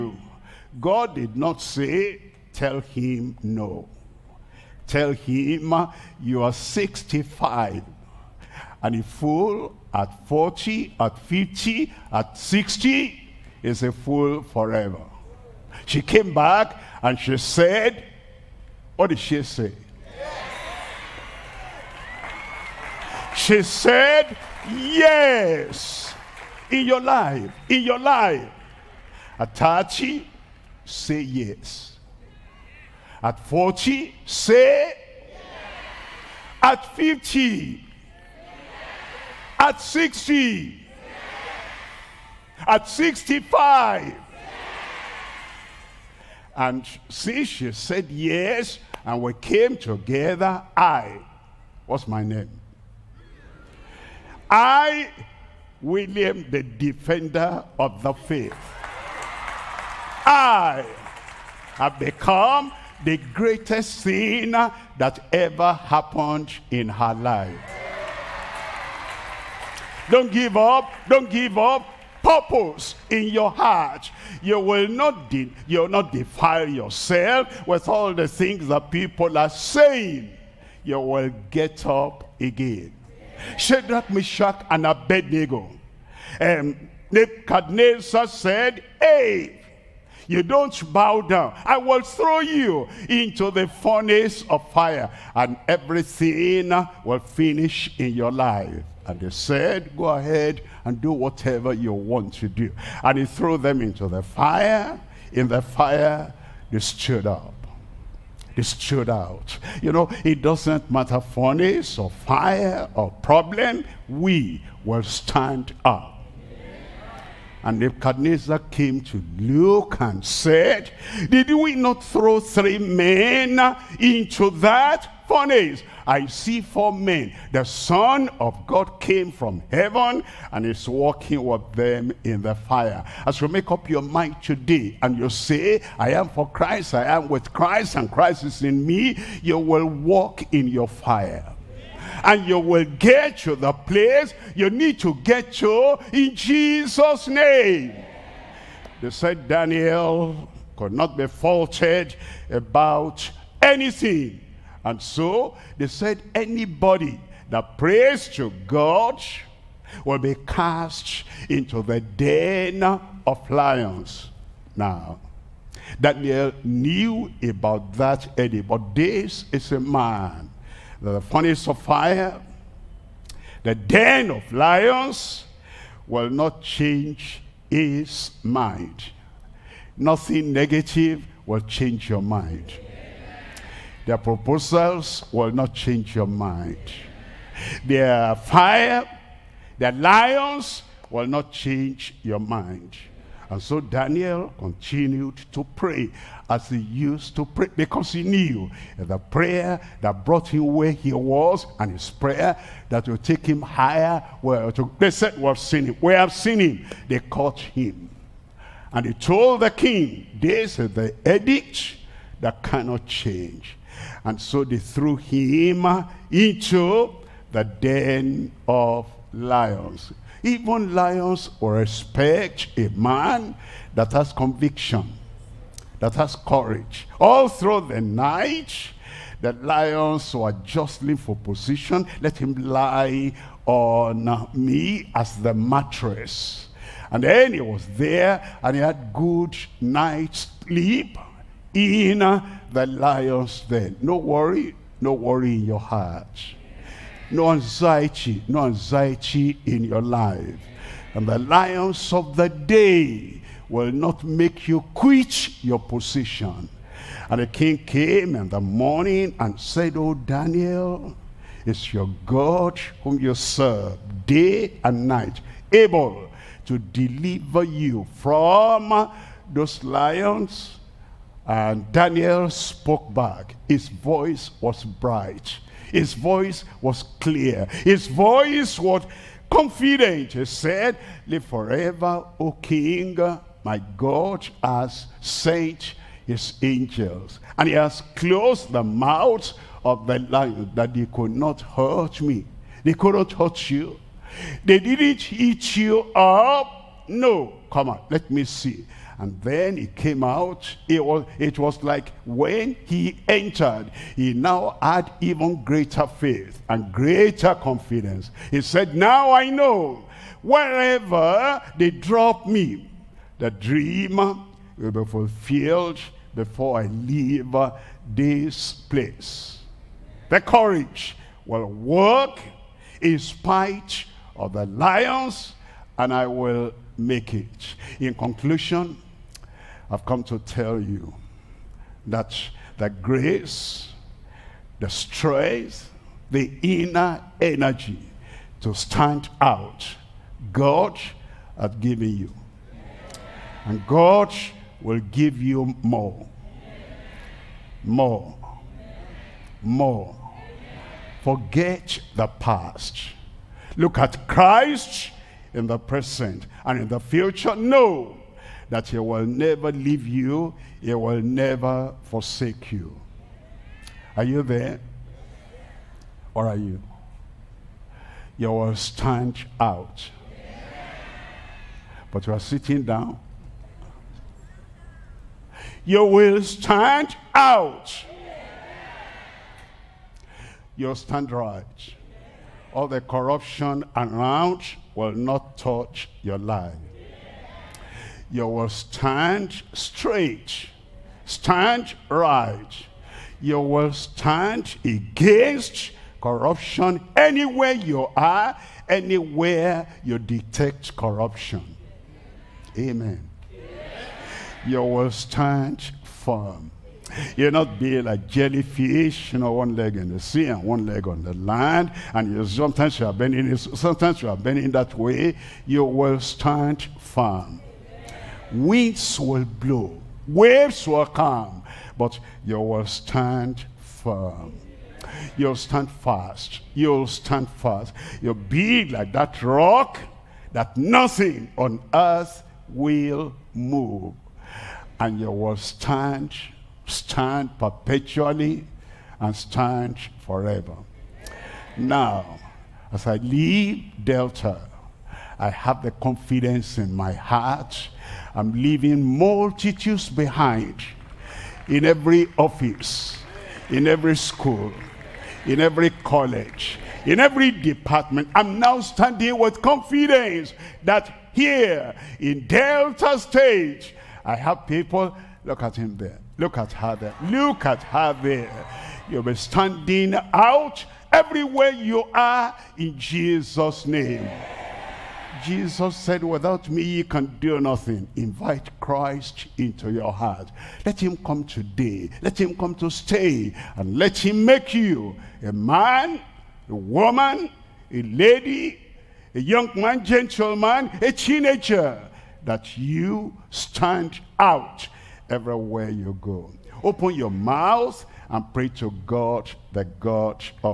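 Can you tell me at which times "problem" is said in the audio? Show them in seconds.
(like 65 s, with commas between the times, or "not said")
113 s.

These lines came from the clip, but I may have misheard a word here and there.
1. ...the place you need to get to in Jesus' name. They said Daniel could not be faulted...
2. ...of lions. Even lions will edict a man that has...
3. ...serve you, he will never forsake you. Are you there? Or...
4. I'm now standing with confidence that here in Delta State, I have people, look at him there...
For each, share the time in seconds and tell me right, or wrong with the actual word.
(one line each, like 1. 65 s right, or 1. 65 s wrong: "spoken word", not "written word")
1. 143 s right
2. 218 s wrong: "respect", not "edict"
3. 359 s wrong: "leave", not "serve"
4. 458 s right.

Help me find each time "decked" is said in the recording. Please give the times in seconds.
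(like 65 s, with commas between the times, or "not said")
not said.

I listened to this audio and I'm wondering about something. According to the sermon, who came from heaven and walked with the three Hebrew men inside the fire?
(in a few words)
The Son of God.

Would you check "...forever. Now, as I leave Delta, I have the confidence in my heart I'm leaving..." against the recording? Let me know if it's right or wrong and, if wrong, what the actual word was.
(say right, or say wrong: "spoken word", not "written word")
right.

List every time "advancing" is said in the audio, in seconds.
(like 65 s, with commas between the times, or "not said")
not said.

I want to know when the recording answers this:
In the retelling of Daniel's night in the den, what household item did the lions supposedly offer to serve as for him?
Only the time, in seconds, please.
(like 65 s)
235 s.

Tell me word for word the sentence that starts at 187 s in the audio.
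Their fire, their lions will not change your mind.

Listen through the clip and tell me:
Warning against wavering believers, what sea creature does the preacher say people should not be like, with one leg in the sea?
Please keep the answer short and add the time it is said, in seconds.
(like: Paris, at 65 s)
jellyfish, at 408 s.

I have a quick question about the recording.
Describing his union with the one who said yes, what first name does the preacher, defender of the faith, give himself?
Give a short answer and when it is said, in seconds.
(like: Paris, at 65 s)
William, at 55 s.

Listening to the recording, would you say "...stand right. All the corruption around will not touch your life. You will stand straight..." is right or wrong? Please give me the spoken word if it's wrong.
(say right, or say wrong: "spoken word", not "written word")
right.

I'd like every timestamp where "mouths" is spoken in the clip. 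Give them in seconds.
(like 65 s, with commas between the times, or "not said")
288 s, 497 s.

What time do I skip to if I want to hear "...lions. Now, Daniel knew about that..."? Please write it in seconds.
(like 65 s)
163 s.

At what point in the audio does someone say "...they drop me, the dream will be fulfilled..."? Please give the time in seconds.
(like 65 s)
311 s.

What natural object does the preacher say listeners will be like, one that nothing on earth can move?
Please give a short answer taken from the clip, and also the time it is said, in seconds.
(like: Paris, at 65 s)
rock, at 429 s.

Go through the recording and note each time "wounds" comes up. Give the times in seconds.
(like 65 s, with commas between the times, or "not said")
not said.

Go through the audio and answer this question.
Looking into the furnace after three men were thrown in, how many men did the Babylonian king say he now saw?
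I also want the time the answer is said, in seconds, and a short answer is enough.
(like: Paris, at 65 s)
4, at 126 s.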